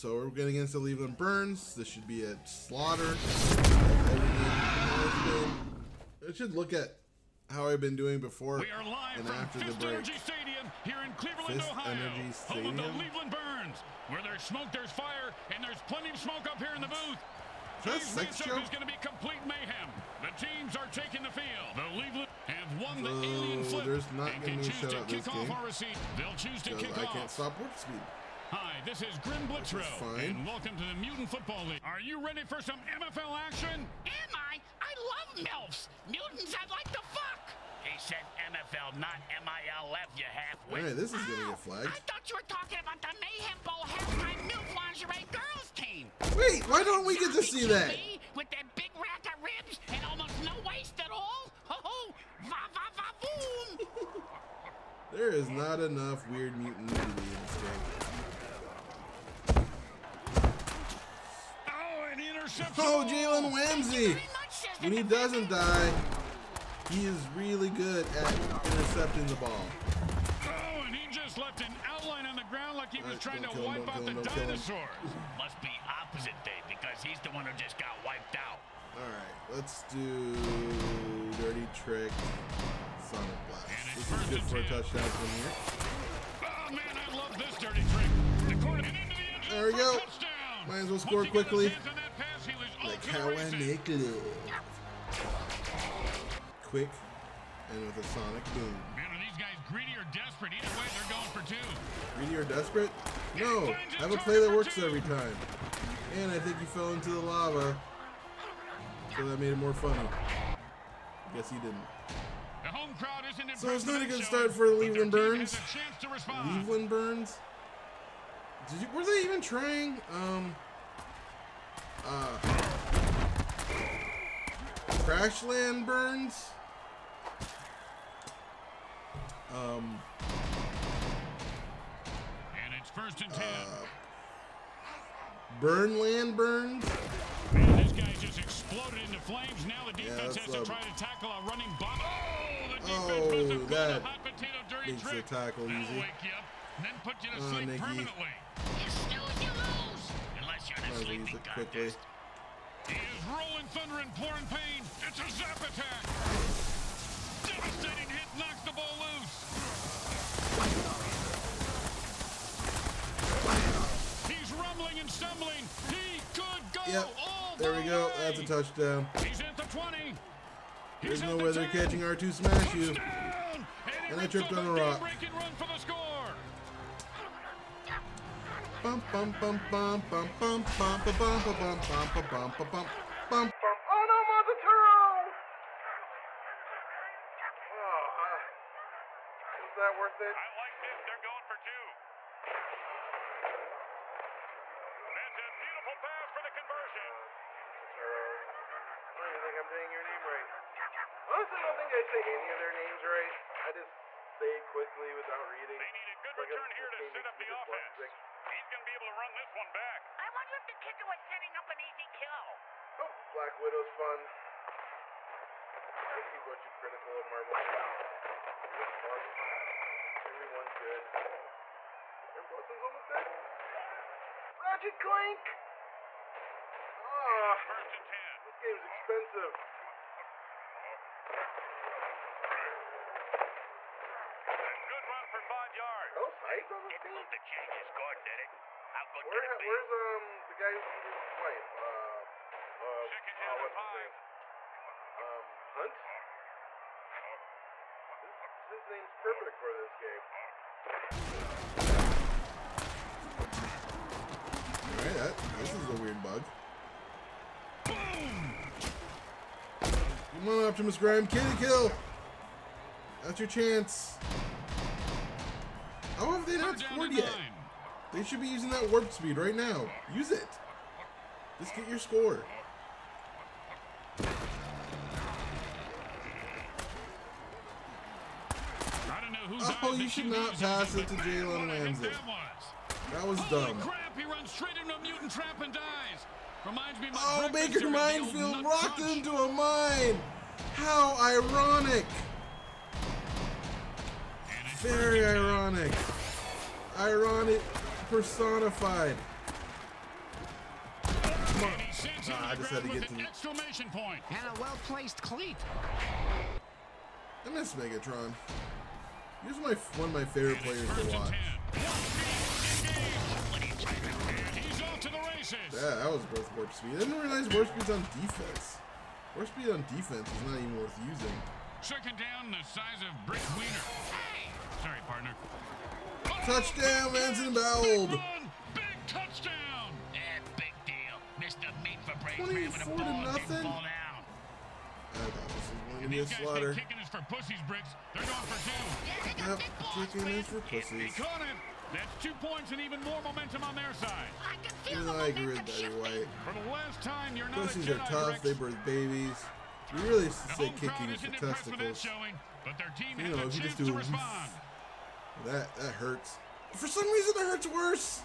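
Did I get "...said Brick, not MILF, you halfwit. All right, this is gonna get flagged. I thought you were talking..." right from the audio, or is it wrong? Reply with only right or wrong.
wrong.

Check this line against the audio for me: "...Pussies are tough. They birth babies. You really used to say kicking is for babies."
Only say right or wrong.
wrong.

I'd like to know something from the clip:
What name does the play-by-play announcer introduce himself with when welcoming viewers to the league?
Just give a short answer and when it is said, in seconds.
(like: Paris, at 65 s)
Grim Blitzro, at 29 s.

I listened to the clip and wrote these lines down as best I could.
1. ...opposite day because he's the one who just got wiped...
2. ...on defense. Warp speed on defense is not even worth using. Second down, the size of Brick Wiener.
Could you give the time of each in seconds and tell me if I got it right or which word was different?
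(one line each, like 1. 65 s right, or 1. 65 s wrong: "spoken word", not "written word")
1. 76 s right
2. 317 s right.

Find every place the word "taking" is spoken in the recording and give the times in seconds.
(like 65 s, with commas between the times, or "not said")
20 s.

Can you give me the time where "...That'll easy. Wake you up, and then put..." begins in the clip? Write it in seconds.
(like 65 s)
145 s.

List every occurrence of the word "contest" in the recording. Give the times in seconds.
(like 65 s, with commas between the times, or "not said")
151 s.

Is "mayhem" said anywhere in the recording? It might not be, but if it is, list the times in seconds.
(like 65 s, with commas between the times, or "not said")
19 s, 43 s.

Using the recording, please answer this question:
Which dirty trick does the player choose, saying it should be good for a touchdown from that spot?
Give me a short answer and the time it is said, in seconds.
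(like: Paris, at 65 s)
Sonic Blast, at 83 s.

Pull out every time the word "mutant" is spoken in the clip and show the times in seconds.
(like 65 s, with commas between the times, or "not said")
30 s, 36 s, 56 s, 285 s.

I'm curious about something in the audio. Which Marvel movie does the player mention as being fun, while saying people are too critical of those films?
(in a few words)
Black Widow.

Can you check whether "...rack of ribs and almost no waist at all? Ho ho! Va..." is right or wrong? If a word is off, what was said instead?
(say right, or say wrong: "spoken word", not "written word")
right.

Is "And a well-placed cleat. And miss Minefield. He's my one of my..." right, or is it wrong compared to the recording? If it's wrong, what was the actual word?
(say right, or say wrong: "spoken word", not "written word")
wrong: "Megatron", not "Minefield".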